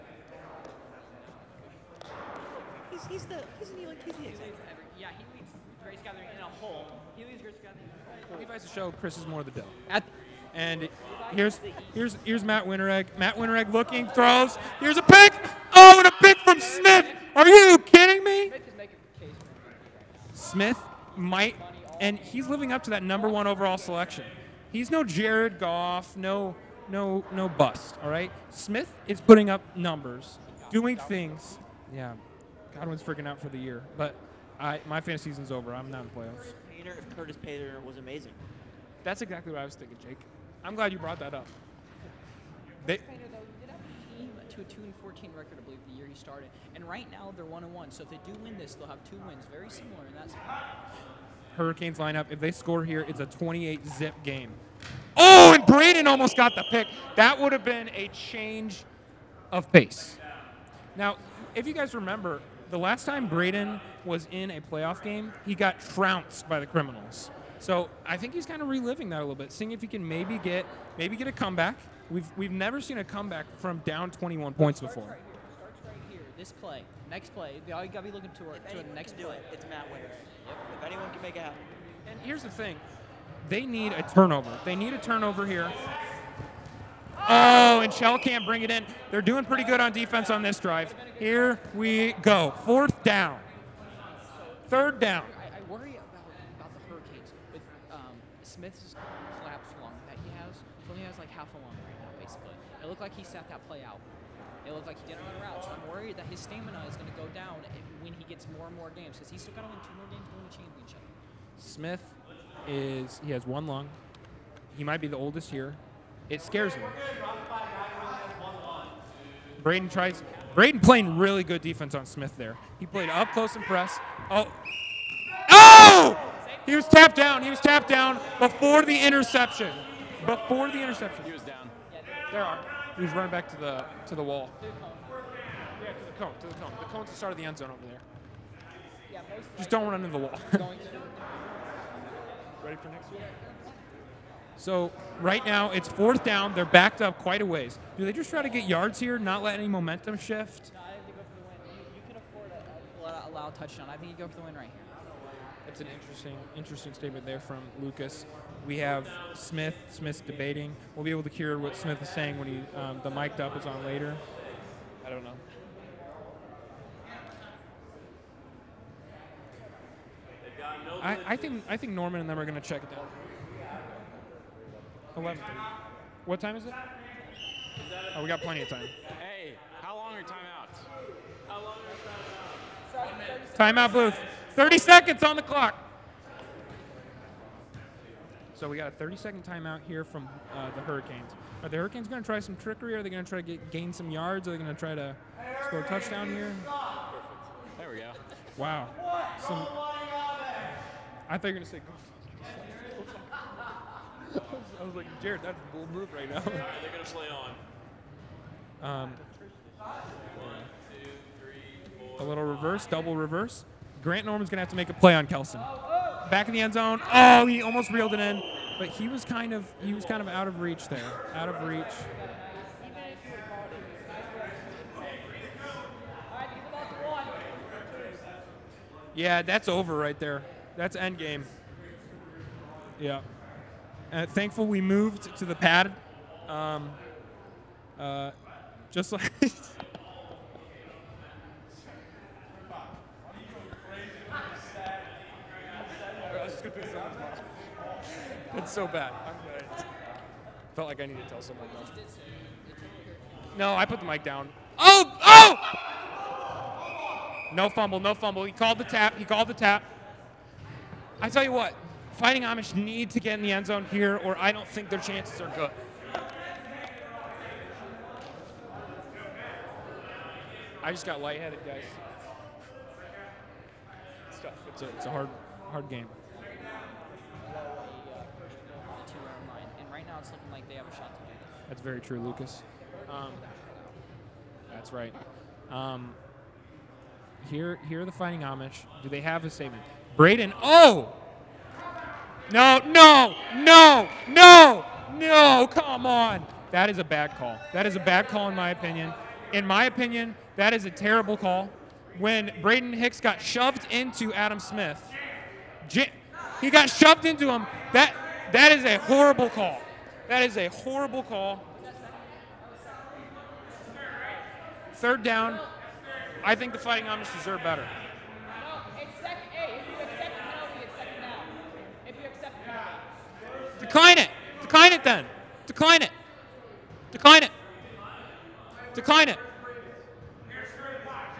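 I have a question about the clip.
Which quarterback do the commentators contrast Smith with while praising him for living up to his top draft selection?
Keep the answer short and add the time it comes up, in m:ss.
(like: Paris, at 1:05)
Jared Goff, at 0:25.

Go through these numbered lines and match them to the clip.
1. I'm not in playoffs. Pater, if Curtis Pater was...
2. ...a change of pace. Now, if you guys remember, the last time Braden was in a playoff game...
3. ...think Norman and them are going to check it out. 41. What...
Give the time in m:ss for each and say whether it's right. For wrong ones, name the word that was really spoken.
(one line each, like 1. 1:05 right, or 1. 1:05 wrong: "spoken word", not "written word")
1. 0:35 right
2. 0:57 right
3. 2:51 wrong: "11", not "41".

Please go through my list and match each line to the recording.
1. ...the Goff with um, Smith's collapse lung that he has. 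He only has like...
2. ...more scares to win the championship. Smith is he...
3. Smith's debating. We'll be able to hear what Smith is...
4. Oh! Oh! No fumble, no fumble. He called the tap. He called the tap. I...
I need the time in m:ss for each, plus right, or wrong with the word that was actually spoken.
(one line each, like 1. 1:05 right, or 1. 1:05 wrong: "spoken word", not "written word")
1. 1:36 wrong: "Hurricanes", not "Goff"
2. 1:49 wrong: "games", not "scares"
3. 2:39 right
4. 4:14 right.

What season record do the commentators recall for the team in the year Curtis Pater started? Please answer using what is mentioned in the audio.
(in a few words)
2 and 14.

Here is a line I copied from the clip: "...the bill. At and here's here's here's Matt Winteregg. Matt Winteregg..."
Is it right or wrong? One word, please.
right.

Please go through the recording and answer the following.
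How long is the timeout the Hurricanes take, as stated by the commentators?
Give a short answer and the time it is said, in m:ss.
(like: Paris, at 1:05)
30 seconds, at 3:09.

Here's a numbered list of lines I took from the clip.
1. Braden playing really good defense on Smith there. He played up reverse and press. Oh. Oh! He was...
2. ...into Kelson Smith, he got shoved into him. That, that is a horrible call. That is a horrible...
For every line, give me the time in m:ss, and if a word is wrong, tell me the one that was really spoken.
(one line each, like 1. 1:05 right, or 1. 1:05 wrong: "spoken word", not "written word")
1. 2:00 wrong: "close", not "reverse"
2. 5:03 wrong: "Adam", not "Kelson".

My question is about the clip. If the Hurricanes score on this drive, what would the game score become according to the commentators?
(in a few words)
28 zip.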